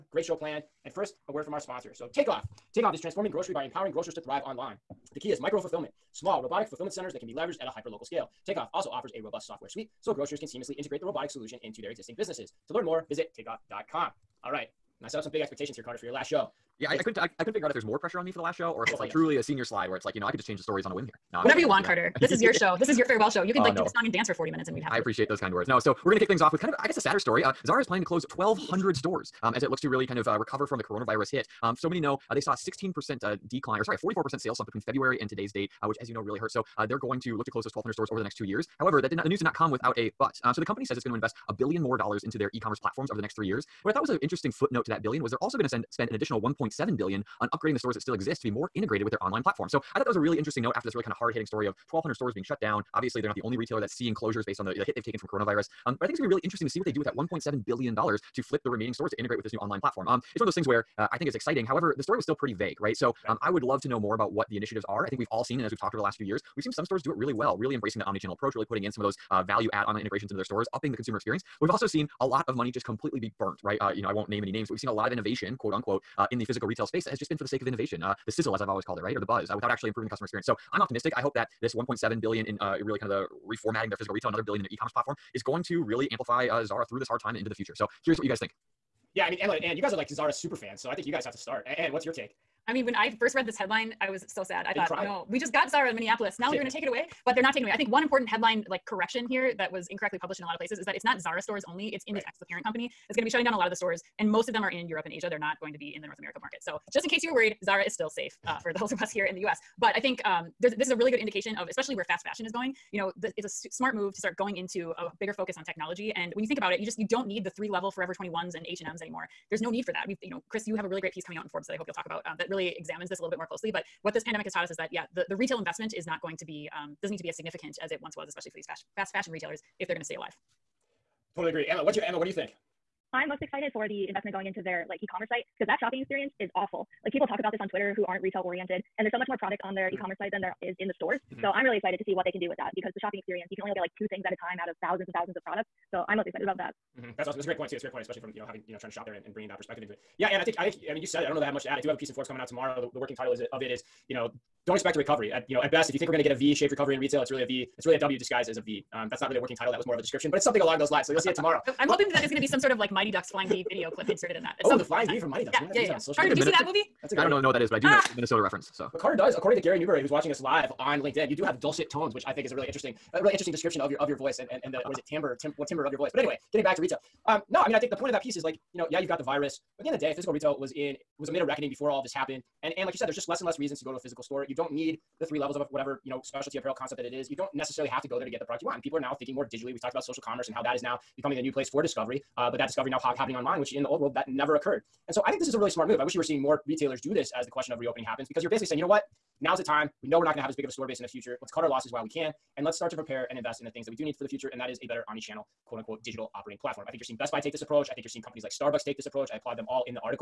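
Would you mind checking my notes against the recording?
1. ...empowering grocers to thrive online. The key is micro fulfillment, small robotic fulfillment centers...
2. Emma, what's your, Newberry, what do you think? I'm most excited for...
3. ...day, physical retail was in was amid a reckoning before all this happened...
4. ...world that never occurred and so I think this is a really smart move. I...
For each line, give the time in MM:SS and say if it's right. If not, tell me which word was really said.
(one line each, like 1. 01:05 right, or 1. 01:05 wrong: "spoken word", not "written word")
1. 00:03 right
2. 02:11 wrong: "Emma", not "Newberry"
3. 02:59 right
4. 03:13 right.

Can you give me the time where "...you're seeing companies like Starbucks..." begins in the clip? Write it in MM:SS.
03:28.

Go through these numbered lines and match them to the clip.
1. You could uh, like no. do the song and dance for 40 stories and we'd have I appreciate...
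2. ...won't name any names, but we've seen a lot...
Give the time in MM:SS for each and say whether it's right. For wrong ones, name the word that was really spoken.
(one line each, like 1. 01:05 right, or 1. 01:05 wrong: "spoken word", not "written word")
1. 00:23 wrong: "minutes", not "stories"
2. 01:14 right.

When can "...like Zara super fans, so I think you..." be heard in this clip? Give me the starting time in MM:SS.
01:29.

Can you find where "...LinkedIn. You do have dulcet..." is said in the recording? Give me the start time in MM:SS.
02:51.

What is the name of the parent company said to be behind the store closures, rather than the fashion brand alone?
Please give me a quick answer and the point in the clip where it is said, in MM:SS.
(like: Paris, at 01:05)
Inditex, at 01:42.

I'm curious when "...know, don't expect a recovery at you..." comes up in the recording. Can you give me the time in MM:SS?
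02:34.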